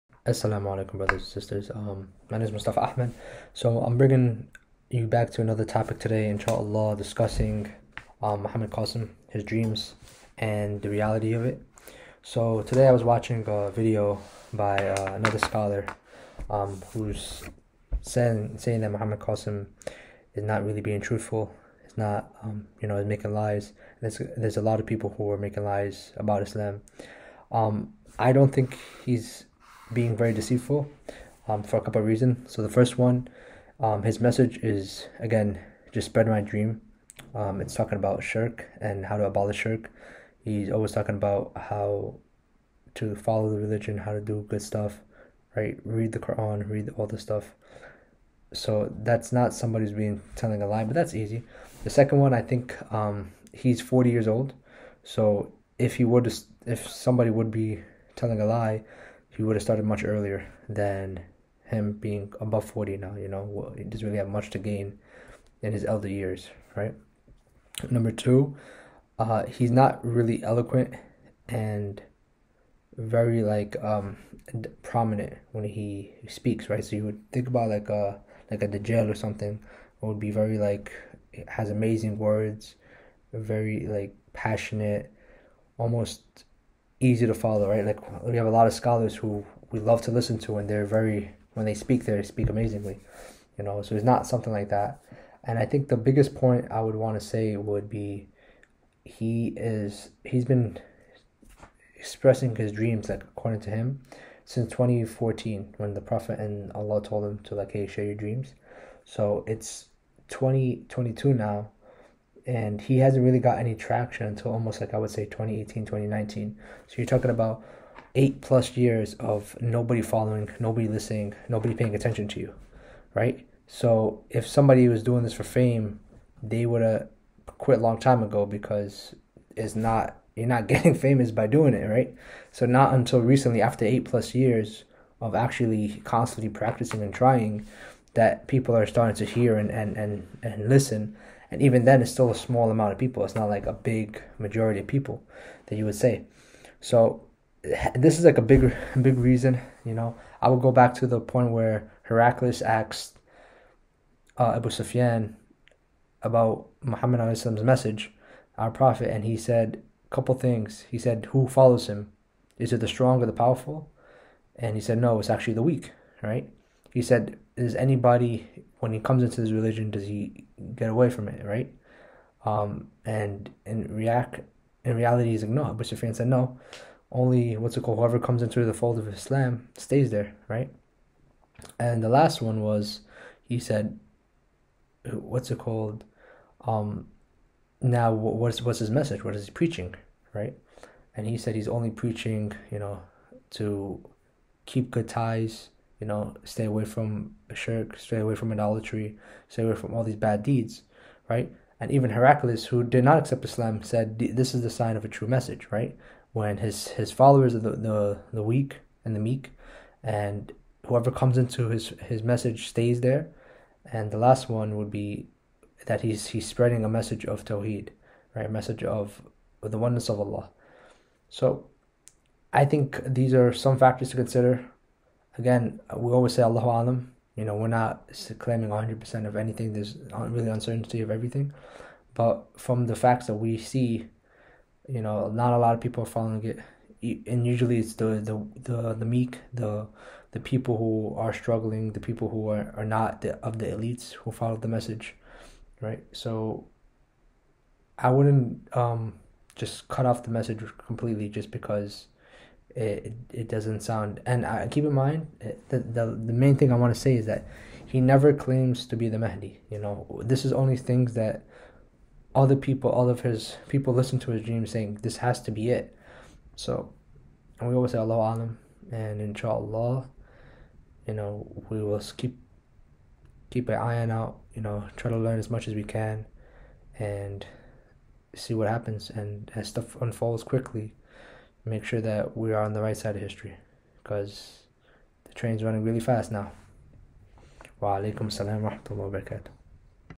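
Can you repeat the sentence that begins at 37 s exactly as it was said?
Um, it's talking about shirk and how to abolish shirk.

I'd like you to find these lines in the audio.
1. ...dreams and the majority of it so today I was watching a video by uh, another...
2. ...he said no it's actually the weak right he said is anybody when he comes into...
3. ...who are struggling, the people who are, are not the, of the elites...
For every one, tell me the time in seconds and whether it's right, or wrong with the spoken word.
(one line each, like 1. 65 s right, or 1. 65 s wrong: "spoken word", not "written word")
1. 9 s wrong: "reality", not "majority"
2. 164 s right
3. 240 s right.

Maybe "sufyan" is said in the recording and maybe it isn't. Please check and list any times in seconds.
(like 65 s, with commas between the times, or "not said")
154 s, 175 s.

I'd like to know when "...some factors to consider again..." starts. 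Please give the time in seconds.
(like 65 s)
223 s.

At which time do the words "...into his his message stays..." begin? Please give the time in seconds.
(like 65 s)
211 s.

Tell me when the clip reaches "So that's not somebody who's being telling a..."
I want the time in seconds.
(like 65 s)
48 s.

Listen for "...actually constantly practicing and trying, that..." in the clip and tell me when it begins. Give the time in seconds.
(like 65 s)
135 s.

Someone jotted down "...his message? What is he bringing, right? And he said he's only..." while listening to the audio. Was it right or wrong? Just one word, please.
wrong.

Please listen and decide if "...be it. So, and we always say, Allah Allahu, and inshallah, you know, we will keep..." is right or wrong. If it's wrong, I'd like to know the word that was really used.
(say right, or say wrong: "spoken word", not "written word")
wrong: "Alam", not "Allahu".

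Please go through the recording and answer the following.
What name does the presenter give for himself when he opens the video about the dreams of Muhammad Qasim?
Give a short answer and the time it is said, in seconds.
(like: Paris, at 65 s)
Mustafa Ahmed, at 2 s.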